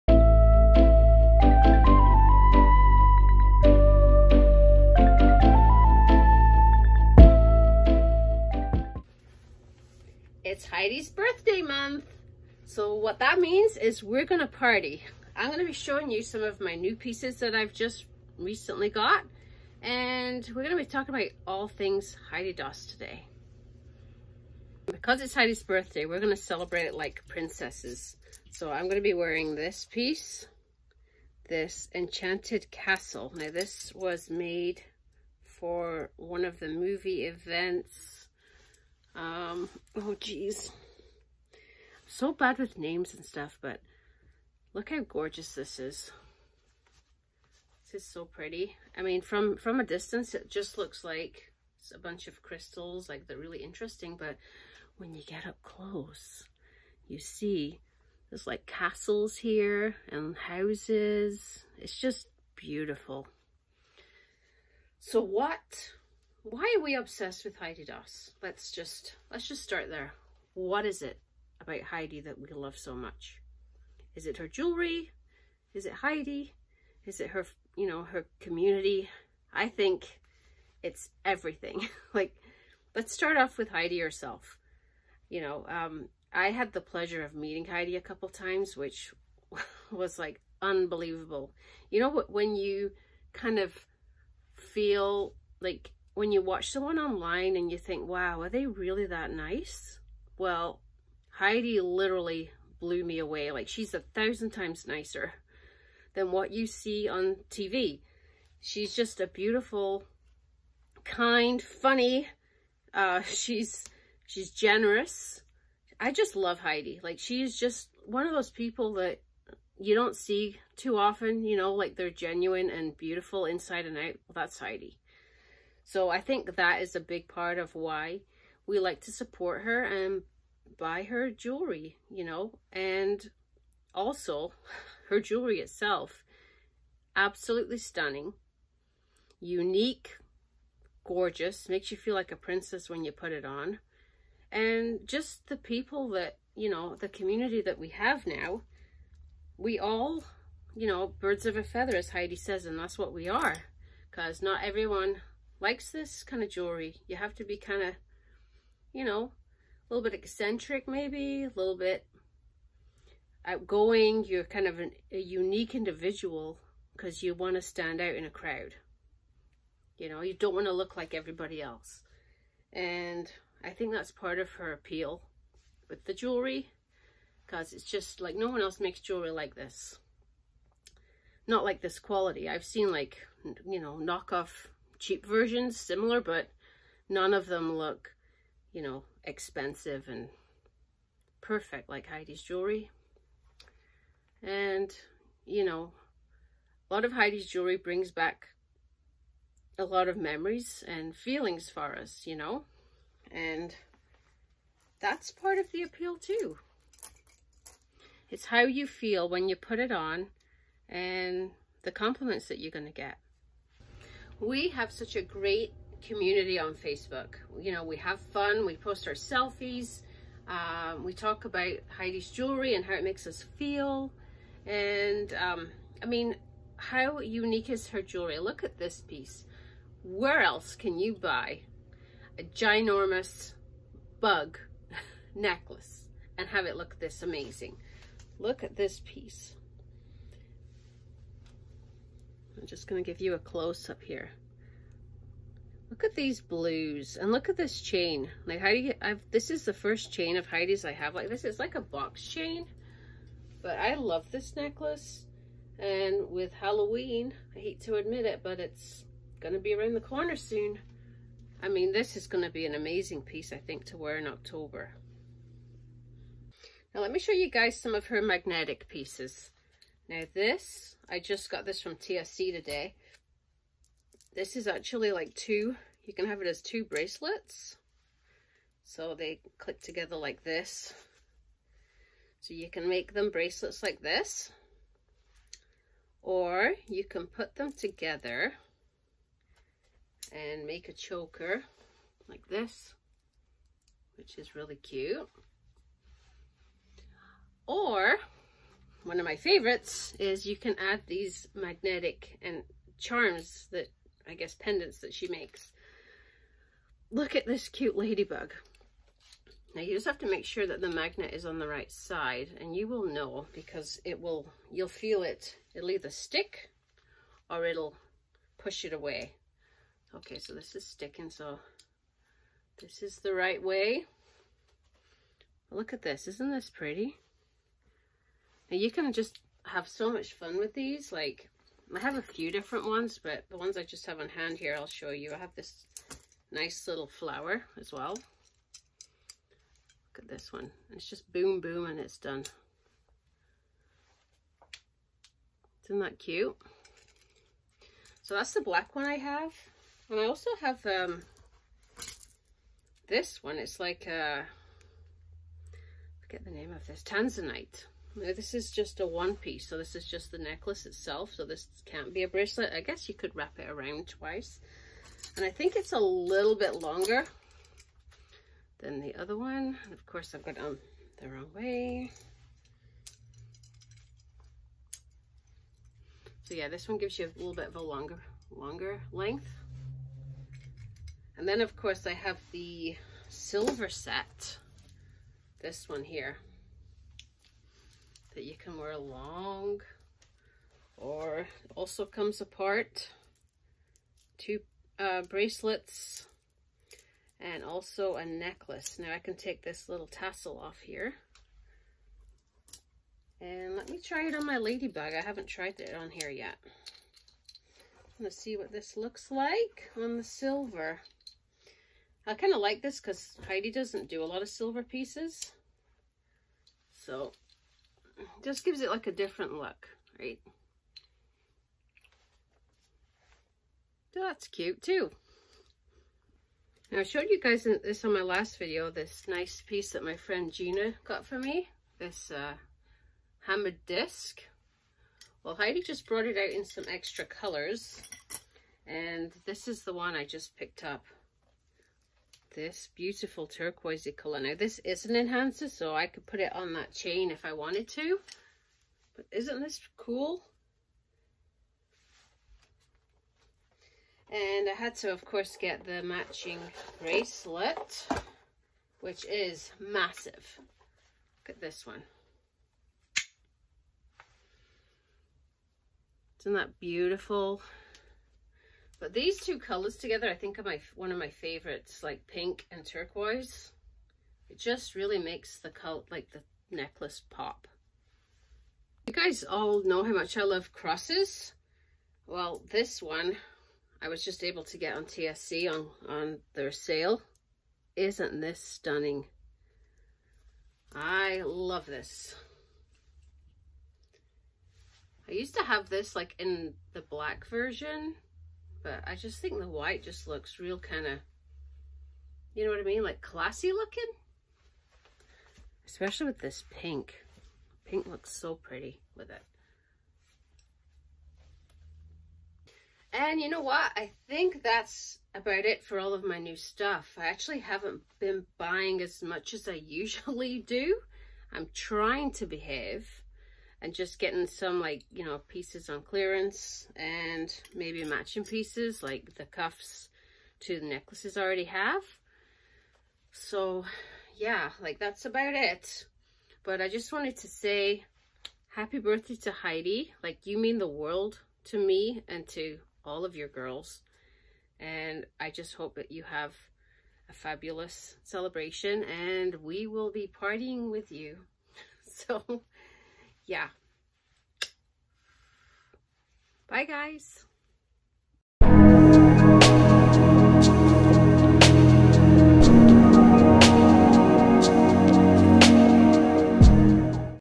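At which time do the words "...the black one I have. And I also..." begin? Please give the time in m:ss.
5:48.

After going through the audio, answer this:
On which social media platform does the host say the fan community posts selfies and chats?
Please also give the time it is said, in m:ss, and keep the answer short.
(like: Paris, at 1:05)
Facebook, at 3:36.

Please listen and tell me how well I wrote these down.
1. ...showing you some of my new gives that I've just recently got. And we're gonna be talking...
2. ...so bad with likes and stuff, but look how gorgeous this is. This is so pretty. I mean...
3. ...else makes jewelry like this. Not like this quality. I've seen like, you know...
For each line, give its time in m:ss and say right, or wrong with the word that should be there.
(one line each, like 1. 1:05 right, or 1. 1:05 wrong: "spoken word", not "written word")
1. 0:15 wrong: "pieces", not "gives"
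2. 0:42 wrong: "names", not "likes"
3. 2:58 right.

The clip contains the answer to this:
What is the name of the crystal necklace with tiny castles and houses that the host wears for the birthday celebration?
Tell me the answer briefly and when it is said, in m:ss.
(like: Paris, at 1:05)
Enchanted Castle, at 0:31.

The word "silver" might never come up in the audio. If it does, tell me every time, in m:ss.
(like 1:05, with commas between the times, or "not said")
6:23, 6:50, 6:54.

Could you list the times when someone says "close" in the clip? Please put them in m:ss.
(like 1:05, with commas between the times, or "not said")
0:55, 4:03.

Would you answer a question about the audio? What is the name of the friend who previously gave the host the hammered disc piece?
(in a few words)
Gina.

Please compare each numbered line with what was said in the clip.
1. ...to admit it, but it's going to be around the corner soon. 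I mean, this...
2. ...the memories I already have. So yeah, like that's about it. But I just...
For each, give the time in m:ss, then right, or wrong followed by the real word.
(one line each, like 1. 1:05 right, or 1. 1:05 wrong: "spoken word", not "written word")
1. 4:17 right
2. 8:50 wrong: "necklaces", not "memories".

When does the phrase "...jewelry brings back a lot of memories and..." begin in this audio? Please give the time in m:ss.
3:17.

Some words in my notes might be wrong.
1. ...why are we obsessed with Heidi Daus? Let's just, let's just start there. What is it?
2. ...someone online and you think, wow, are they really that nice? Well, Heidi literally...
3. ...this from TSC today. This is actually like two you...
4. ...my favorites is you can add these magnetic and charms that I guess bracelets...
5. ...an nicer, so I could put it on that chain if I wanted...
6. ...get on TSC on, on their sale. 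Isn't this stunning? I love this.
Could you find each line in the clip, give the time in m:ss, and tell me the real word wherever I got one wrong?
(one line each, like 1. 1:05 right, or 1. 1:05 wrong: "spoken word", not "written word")
1. 1:06 right
2. 1:36 right
3. 4:31 right
4. 4:59 wrong: "pendants", not "bracelets"
5. 7:25 wrong: "enhancer", not "nicer"
6. 8:04 right.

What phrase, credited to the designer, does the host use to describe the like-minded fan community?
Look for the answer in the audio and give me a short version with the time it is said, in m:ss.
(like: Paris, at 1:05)
birds of a feather, at 2:31.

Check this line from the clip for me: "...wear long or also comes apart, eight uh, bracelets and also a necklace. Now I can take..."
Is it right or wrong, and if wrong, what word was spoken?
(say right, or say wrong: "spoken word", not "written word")
wrong: "two", not "eight".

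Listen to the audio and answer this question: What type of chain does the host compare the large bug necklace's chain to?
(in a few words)
box chain.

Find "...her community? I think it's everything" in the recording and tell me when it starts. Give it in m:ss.
1:18.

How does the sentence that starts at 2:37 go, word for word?
You have to be kind of, you know, a little bit eccentric maybe, a little bit outgoing.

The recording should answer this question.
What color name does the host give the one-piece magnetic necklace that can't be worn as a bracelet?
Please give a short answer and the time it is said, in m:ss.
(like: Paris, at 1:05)
Tanzanite, at 5:57.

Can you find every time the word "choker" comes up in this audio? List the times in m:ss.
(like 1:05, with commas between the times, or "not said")
4:50.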